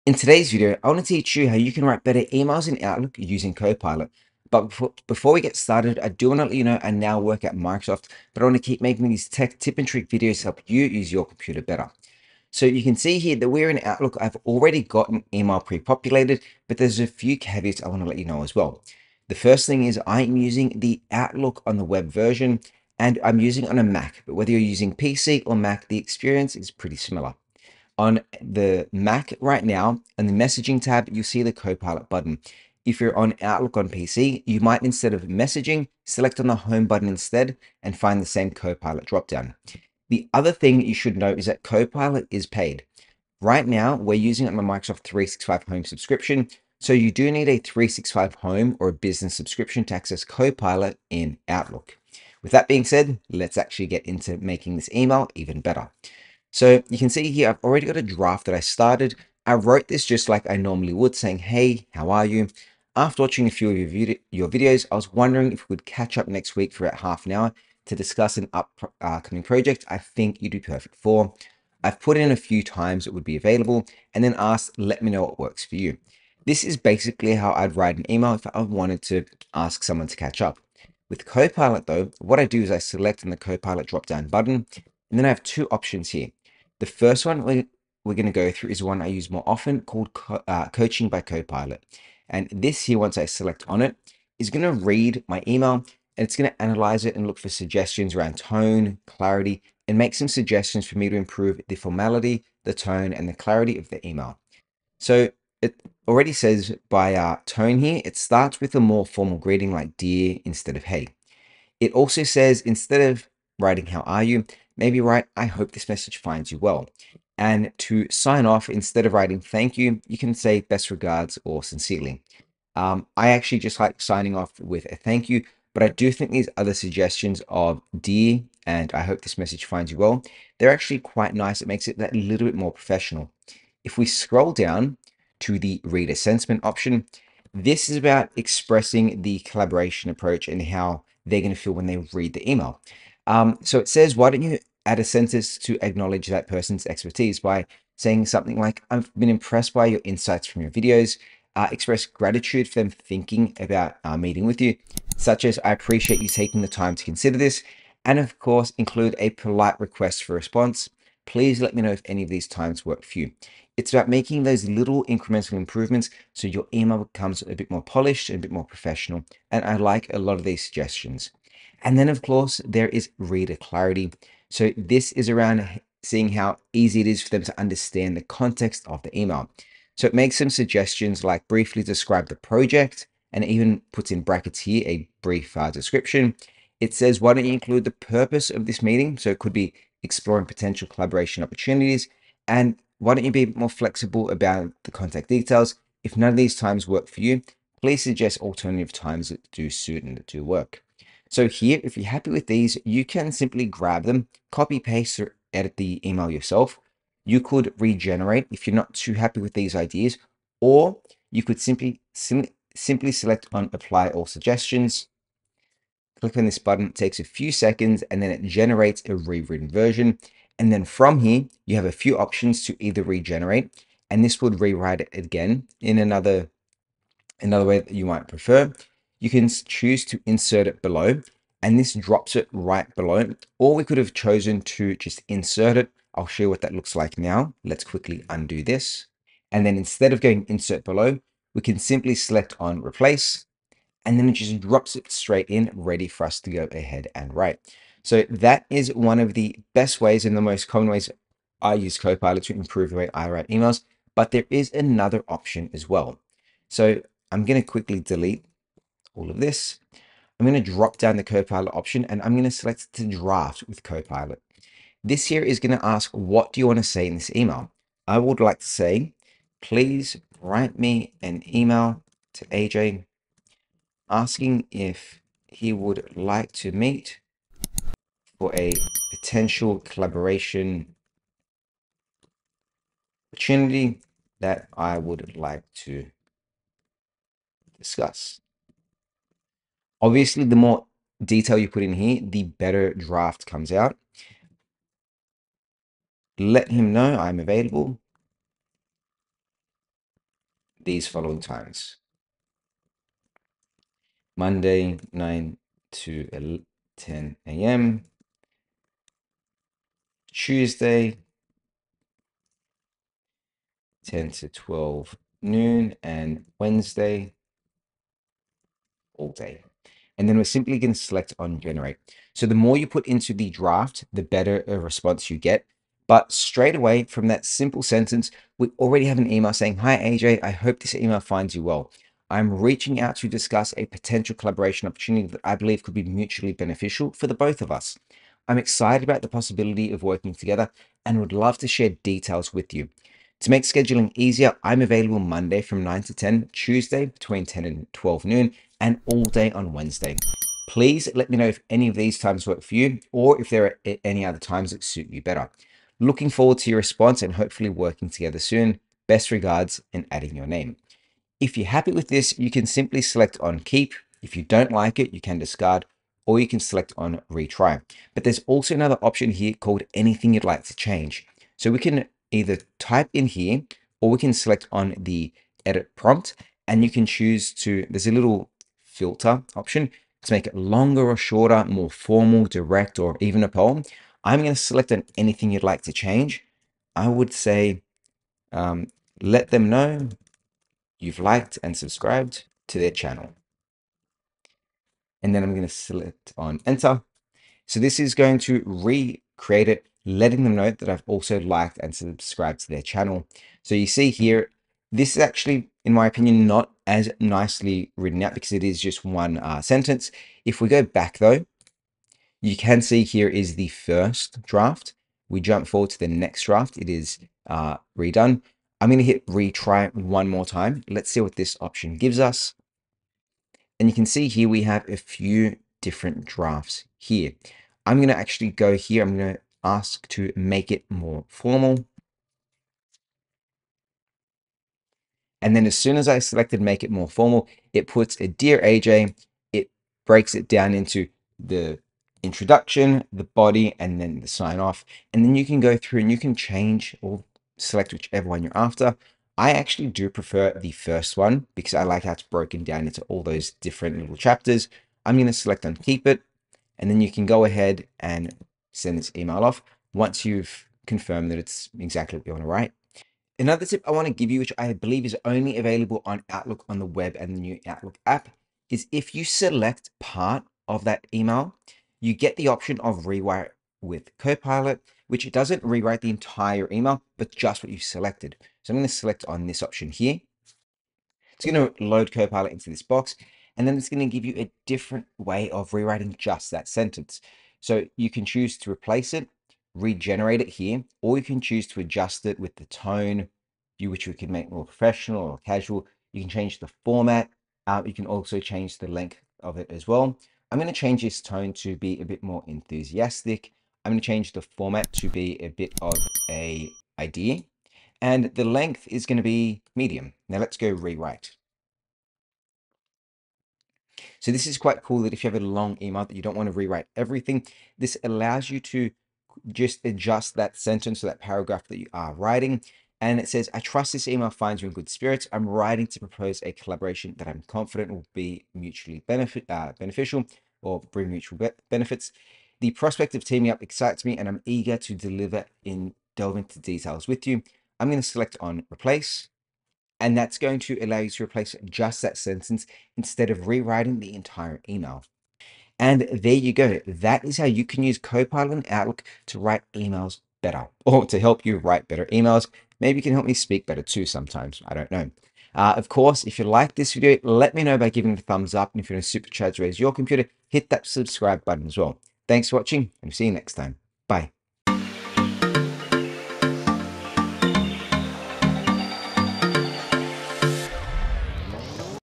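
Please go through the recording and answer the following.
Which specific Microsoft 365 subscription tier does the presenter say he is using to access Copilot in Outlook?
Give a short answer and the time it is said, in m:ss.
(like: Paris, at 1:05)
Microsoft 365 Home, at 0:44.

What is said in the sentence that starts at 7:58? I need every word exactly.
So I'm going to select on this option here.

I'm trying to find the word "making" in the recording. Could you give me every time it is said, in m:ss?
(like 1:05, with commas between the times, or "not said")
0:08, 0:54, 2:44.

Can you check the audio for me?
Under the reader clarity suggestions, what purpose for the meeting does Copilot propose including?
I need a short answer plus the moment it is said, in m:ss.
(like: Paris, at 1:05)
Exploring potential collaboration opportunities, at 3:10.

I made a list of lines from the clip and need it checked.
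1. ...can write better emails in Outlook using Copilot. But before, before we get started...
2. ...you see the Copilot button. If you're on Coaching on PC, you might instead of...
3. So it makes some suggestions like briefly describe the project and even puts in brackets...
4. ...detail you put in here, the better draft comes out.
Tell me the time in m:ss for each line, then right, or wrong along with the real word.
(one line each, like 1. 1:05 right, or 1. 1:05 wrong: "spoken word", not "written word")
1. 0:01 right
2. 0:31 wrong: "Outlook", not "Coaching"
3. 2:59 right
4. 4:51 right.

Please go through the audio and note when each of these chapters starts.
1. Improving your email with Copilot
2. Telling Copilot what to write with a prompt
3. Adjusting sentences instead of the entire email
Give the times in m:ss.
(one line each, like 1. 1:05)
1. 0:56
2. 4:16
3. 7:42.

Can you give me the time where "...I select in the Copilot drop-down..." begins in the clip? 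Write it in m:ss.
1:22.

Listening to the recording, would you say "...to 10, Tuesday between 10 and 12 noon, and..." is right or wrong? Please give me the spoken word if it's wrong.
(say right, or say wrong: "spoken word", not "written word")
right.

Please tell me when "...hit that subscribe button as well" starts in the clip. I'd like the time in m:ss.
9:20.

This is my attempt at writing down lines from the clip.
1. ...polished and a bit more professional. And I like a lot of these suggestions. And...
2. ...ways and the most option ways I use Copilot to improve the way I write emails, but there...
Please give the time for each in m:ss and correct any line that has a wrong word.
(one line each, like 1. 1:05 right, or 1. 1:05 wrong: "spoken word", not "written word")
1. 2:47 right
2. 4:10 wrong: "common", not "option".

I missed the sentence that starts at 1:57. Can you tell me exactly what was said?
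And to sign off, instead of writing thank you, you can say best regards or sincerely.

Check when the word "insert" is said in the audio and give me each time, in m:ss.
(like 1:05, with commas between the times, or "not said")
3:50, 3:55, 4:00.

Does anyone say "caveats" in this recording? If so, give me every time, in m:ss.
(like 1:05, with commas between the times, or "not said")
0:17.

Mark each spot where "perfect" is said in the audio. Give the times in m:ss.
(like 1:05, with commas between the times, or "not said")
1:10.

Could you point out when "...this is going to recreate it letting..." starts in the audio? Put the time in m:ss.
6:37.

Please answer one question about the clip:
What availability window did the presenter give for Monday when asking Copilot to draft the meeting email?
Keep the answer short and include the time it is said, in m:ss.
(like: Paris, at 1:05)
9 to 10 a.m., at 5:05.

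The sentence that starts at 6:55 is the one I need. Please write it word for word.
We jump forward to the next draft.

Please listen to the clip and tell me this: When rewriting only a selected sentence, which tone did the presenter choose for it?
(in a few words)
Enthusiastic.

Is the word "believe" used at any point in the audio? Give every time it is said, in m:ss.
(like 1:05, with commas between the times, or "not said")
5:35, 7:44.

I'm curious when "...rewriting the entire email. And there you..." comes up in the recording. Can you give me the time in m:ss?
9:03.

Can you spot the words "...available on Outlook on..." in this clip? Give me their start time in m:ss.
7:45.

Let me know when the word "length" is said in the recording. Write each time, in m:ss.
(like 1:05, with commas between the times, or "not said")
8:18, 8:28.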